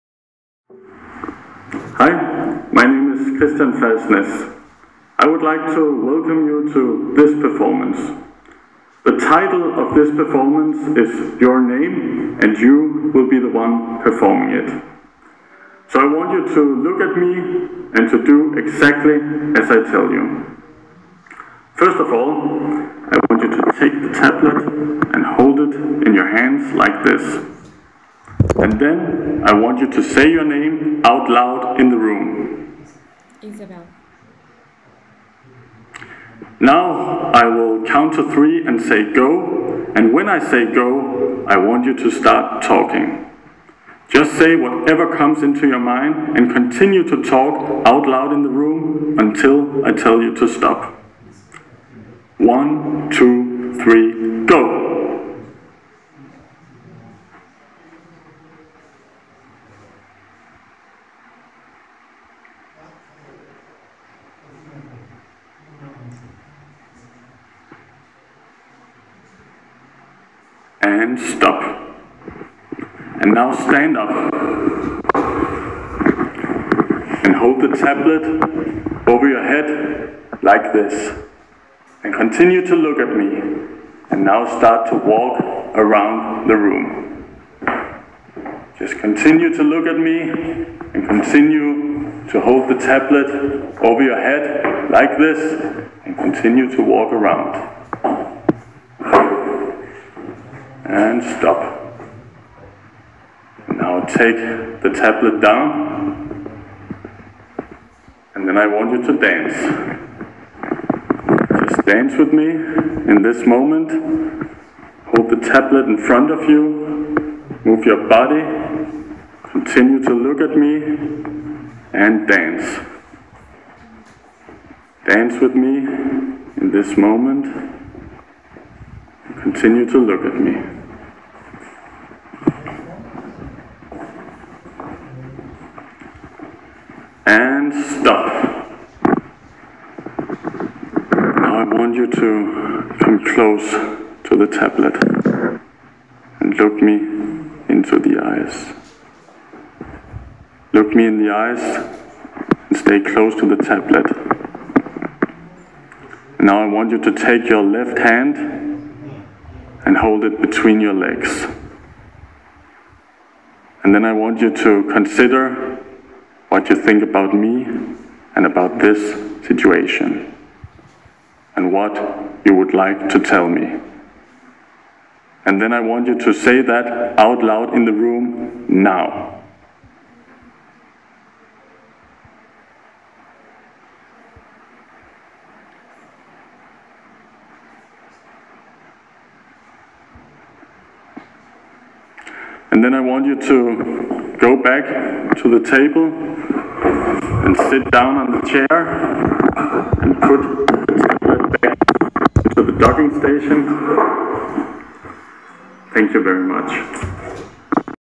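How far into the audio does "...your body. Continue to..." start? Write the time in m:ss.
1:57.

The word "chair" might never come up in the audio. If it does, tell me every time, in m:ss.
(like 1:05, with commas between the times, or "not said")
3:18.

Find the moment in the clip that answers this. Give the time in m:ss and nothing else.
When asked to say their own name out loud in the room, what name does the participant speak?
0:33.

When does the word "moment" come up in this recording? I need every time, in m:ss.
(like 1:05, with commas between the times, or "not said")
1:53, 2:06.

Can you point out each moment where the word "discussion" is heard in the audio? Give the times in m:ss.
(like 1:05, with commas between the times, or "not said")
not said.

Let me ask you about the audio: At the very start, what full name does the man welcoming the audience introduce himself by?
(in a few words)
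Christian Felsnes.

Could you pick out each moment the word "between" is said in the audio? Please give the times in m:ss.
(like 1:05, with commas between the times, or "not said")
2:40.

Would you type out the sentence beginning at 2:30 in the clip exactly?
Look me in the eyes and stay close to the tablet.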